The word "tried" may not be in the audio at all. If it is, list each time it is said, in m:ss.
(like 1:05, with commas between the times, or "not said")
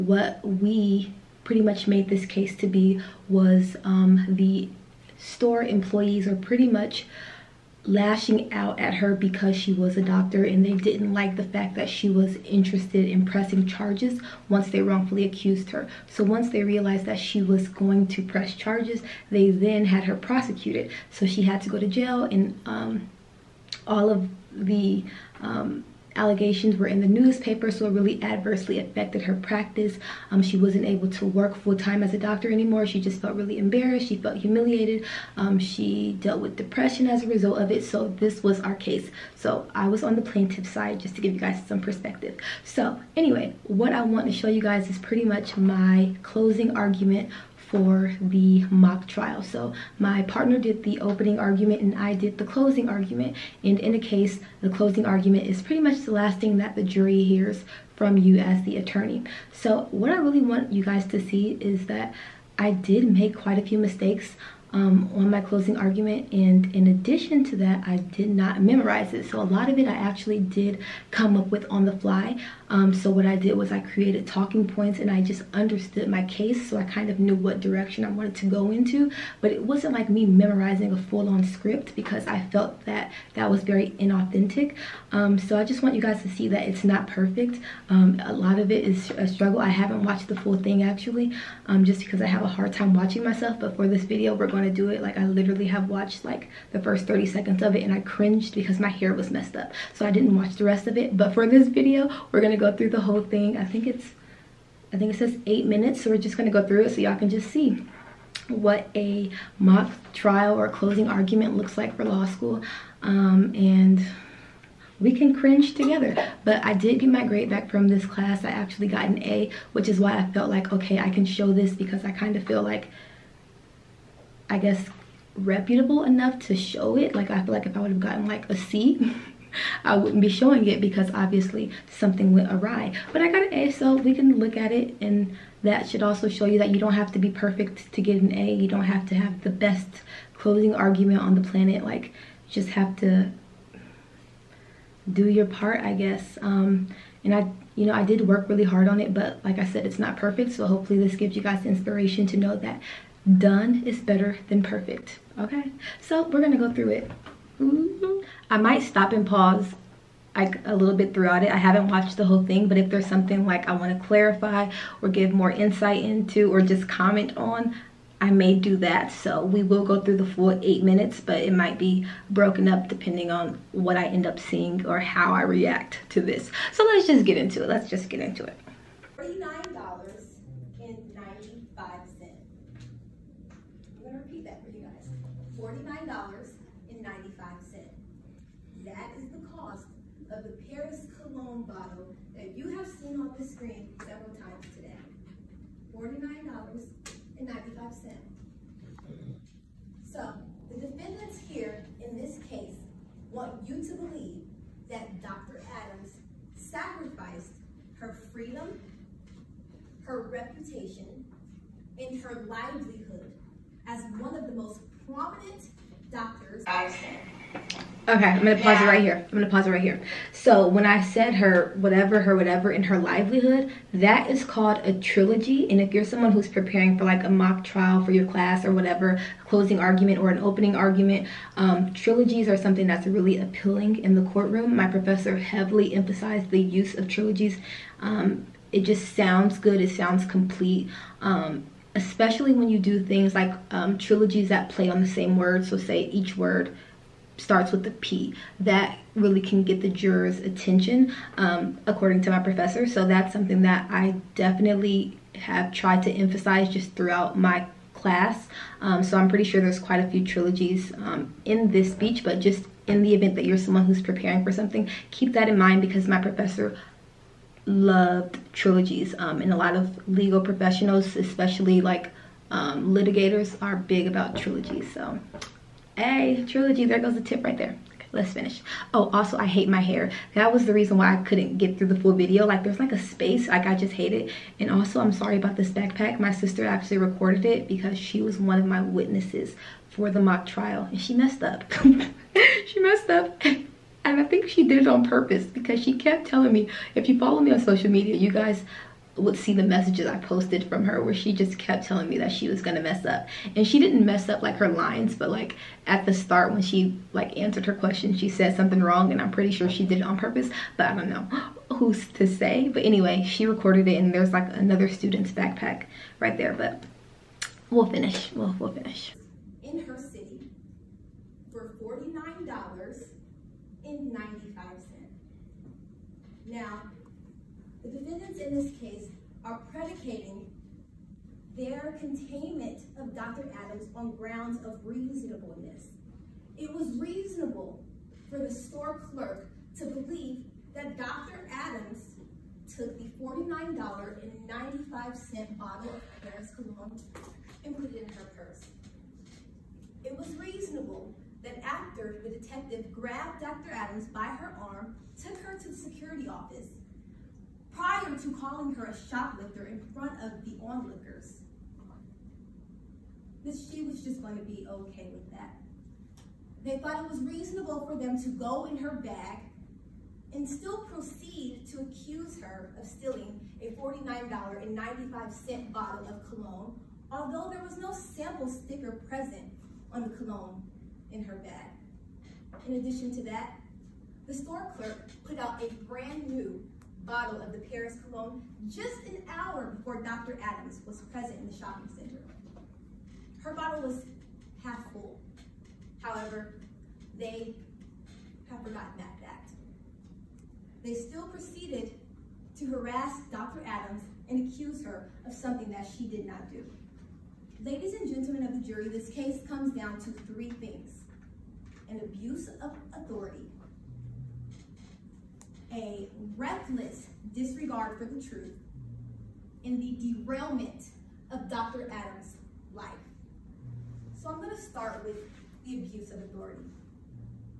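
4:15.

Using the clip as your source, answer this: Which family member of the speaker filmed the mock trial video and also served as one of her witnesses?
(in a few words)
Sister.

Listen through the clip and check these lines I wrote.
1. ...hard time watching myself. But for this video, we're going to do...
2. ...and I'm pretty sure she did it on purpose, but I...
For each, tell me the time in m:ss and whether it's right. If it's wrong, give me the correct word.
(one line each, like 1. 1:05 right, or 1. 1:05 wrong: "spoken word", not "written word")
1. 1:32 right
2. 5:09 right.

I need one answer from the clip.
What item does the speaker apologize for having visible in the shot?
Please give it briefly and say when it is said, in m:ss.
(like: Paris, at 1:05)
Another student's backpack, at 5:14.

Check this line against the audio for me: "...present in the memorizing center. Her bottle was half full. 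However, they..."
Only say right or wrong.
wrong.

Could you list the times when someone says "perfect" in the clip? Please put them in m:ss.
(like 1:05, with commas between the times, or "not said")
1:27, 2:17, 2:30, 2:34.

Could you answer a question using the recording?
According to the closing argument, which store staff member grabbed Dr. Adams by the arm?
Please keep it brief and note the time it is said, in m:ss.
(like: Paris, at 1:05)
The detective, at 5:52.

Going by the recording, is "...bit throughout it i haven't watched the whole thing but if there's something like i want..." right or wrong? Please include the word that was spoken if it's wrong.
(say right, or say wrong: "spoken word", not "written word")
right.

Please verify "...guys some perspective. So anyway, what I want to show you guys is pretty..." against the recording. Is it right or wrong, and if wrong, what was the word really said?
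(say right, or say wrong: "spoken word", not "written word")
right.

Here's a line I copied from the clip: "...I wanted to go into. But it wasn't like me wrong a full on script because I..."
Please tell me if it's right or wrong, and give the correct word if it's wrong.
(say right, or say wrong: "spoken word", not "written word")
wrong: "memorizing", not "wrong".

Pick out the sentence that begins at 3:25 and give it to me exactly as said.
Adams sacrificed her freedom, her reputation, and her livelihood as one of the most prominent doctors.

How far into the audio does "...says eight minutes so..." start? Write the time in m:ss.
1:45.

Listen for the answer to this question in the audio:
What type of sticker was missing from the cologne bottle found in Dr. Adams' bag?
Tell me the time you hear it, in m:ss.
6:17.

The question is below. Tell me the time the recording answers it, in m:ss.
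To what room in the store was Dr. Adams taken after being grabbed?
5:55.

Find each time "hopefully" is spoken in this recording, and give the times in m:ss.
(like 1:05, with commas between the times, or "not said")
2:30.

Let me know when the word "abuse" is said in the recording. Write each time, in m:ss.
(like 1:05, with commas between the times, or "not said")
6:52, 7:05.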